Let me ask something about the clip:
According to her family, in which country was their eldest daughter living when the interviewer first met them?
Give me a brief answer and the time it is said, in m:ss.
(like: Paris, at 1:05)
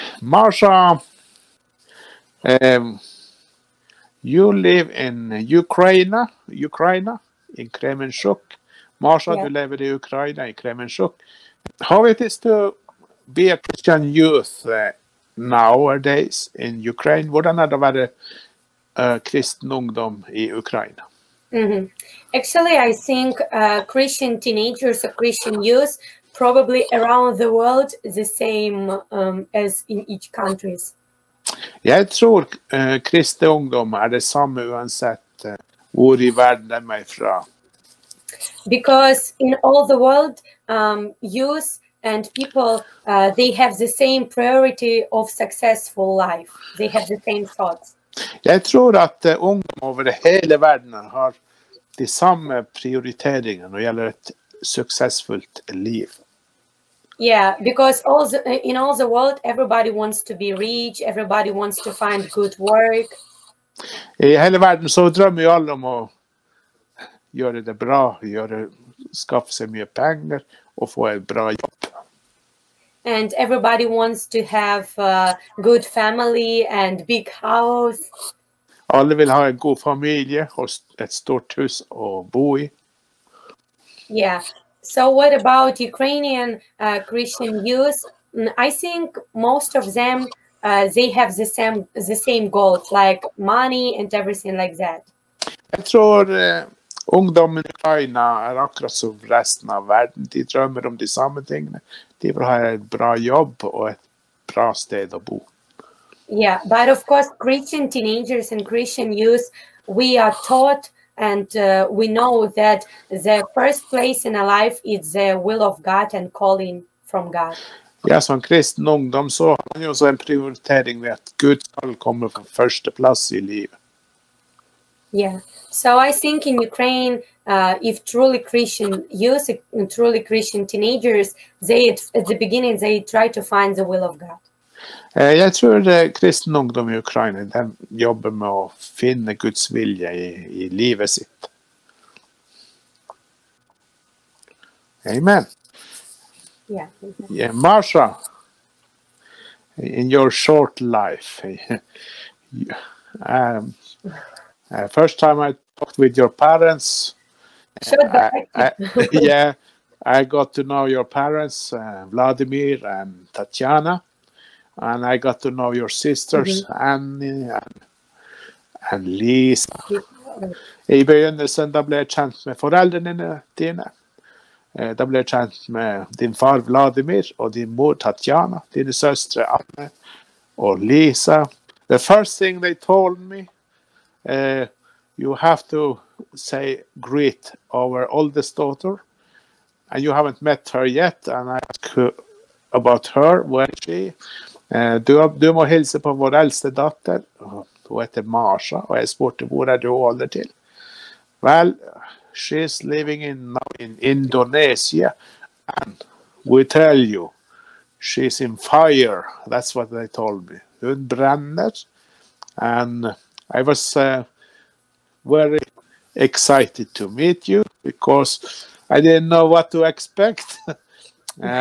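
Indonesia, at 3:23.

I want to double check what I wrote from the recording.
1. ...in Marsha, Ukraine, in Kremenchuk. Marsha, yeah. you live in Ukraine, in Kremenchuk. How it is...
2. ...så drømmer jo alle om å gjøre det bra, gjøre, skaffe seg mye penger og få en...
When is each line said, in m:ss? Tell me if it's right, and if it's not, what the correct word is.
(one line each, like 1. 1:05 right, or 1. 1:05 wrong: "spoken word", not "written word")
1. 0:04 wrong: "Ukraine", not "Marsha"
2. 1:04 right.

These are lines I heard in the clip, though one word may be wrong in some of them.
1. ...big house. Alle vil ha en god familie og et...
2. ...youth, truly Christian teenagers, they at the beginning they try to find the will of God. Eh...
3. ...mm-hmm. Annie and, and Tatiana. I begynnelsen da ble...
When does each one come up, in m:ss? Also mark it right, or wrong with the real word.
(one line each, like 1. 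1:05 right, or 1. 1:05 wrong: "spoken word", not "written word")
1. 1:17 right
2. 2:09 right
3. 2:46 wrong: "Lisa", not "Tatiana".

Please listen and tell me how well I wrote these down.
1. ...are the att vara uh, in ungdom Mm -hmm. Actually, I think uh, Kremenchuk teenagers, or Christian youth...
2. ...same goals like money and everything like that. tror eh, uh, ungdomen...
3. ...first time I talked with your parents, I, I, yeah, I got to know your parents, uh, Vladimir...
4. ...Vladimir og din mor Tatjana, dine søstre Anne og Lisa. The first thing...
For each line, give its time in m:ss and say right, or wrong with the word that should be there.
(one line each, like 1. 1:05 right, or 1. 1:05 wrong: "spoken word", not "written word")
1. 0:17 wrong: "Christian", not "Kremenchuk"
2. 1:32 right
3. 2:34 right
4. 2:56 right.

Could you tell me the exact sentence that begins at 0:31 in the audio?
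Jeg tror uh, eh, kristne ungdom er det samme uansett uh, eh, hvor i verden de er fra.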